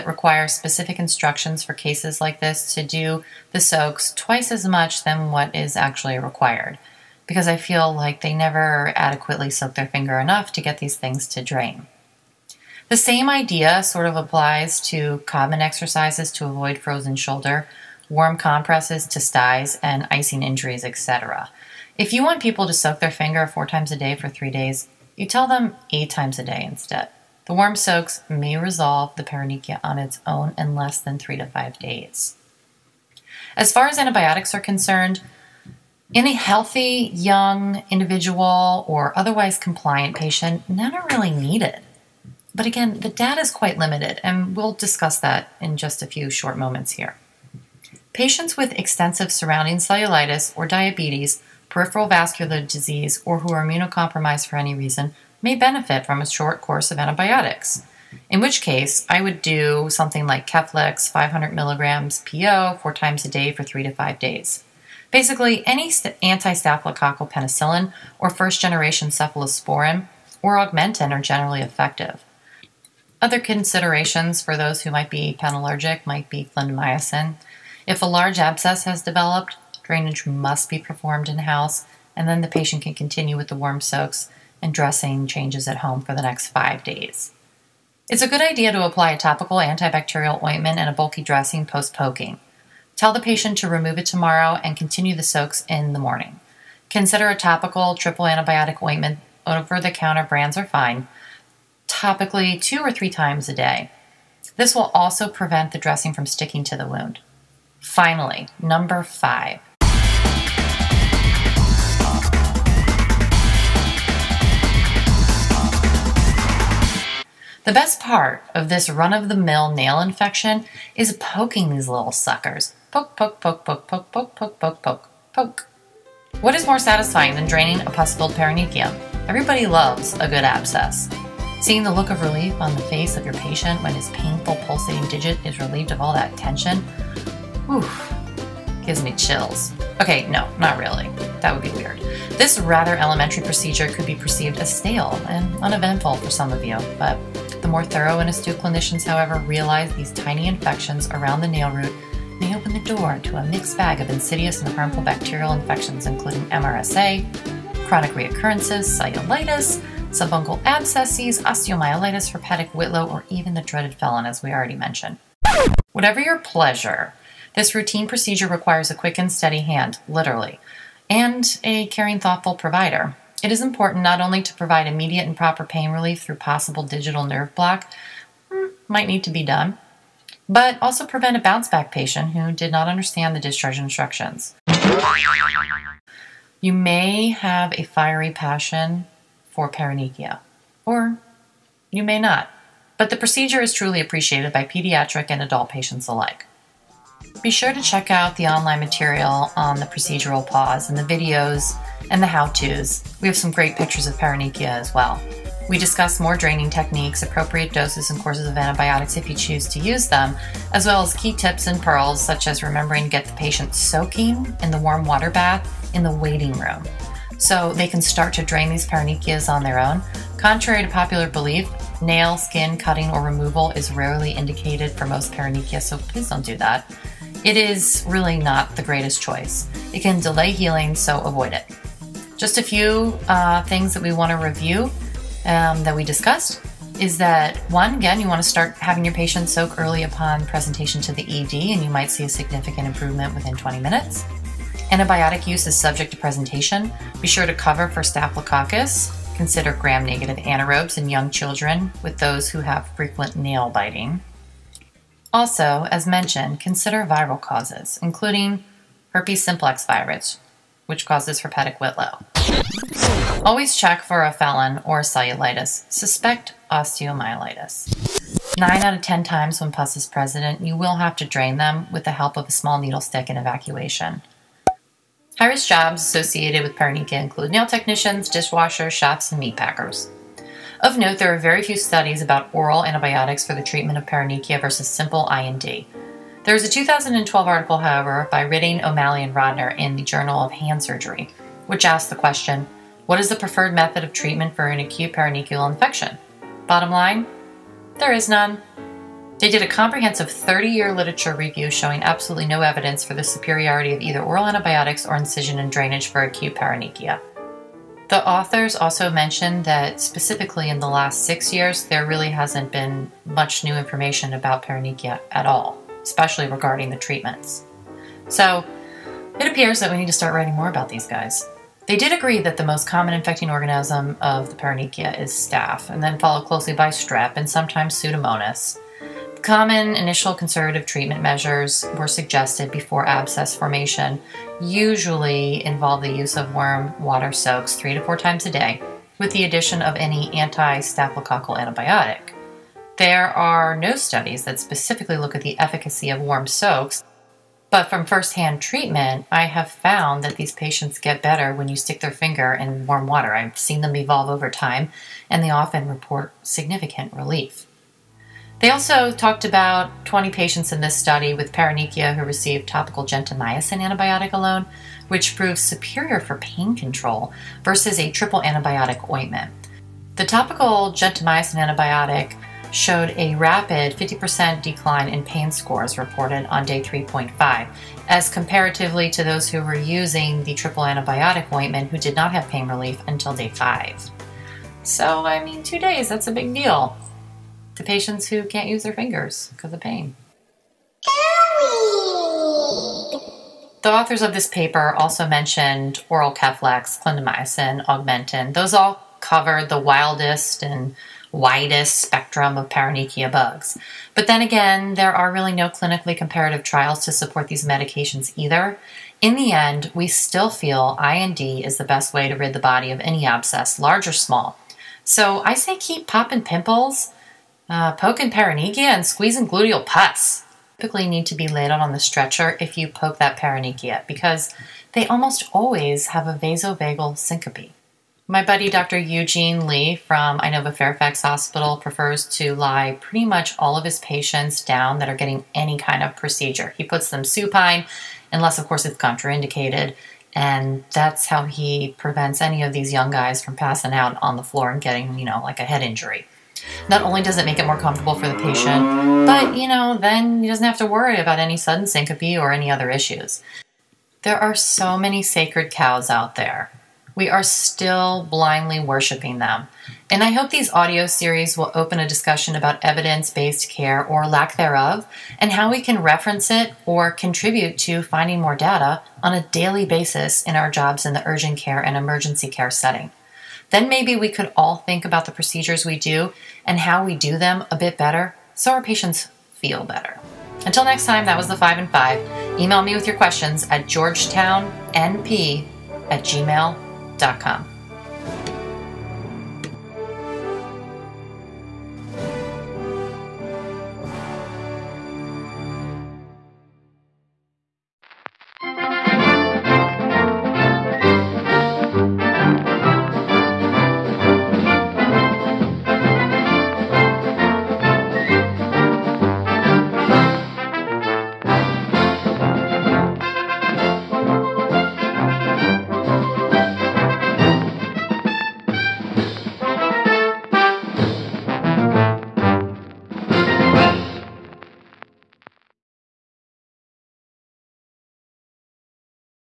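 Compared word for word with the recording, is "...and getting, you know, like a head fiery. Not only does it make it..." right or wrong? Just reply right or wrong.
wrong.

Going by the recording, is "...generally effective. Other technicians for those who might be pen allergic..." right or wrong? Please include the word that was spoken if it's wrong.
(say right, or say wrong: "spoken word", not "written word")
wrong: "considerations", not "technicians".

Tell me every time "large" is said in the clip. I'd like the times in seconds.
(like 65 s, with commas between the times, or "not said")
78 s, 413 s.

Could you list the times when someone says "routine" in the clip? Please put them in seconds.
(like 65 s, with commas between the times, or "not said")
167 s.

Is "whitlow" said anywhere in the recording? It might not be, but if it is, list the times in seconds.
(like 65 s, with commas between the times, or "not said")
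162 s, 261 s.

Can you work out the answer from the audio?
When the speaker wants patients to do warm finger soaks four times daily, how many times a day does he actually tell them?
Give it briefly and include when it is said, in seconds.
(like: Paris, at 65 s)
8, at 25 s.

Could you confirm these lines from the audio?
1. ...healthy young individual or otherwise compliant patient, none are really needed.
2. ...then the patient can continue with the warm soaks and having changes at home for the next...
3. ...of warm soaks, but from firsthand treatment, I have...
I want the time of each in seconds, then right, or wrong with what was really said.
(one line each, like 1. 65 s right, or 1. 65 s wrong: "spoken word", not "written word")
1. 36 s right
2. 82 s wrong: "dressing", not "having"
3. 346 s right.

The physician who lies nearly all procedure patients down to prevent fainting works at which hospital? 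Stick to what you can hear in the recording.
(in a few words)
Inova Fairfax Hospital.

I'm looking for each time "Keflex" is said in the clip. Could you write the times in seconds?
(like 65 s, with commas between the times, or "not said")
60 s, 396 s.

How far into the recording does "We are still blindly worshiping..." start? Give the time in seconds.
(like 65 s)
457 s.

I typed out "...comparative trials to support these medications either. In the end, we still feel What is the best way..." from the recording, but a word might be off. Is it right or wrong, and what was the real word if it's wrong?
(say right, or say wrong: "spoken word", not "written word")
wrong: "IND", not "What".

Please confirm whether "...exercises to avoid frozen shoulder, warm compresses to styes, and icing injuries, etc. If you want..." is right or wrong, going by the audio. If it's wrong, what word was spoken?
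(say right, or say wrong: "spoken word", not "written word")
right.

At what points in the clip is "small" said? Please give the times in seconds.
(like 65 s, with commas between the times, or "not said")
272 s, 414 s.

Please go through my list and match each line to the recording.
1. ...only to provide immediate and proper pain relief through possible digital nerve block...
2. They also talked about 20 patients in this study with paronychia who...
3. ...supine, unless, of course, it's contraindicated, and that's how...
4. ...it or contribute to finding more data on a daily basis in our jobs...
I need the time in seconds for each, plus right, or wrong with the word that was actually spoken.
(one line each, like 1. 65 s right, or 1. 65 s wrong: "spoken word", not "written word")
1. 174 s right
2. 358 s right
3. 437 s right
4. 466 s right.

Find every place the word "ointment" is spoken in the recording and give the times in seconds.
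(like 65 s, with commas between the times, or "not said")
90 s, 98 s, 369 s, 381 s.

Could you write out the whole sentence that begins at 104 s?
This will also prevent the dressing from sticking to the wound.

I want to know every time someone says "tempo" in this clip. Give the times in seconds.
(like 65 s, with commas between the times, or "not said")
not said.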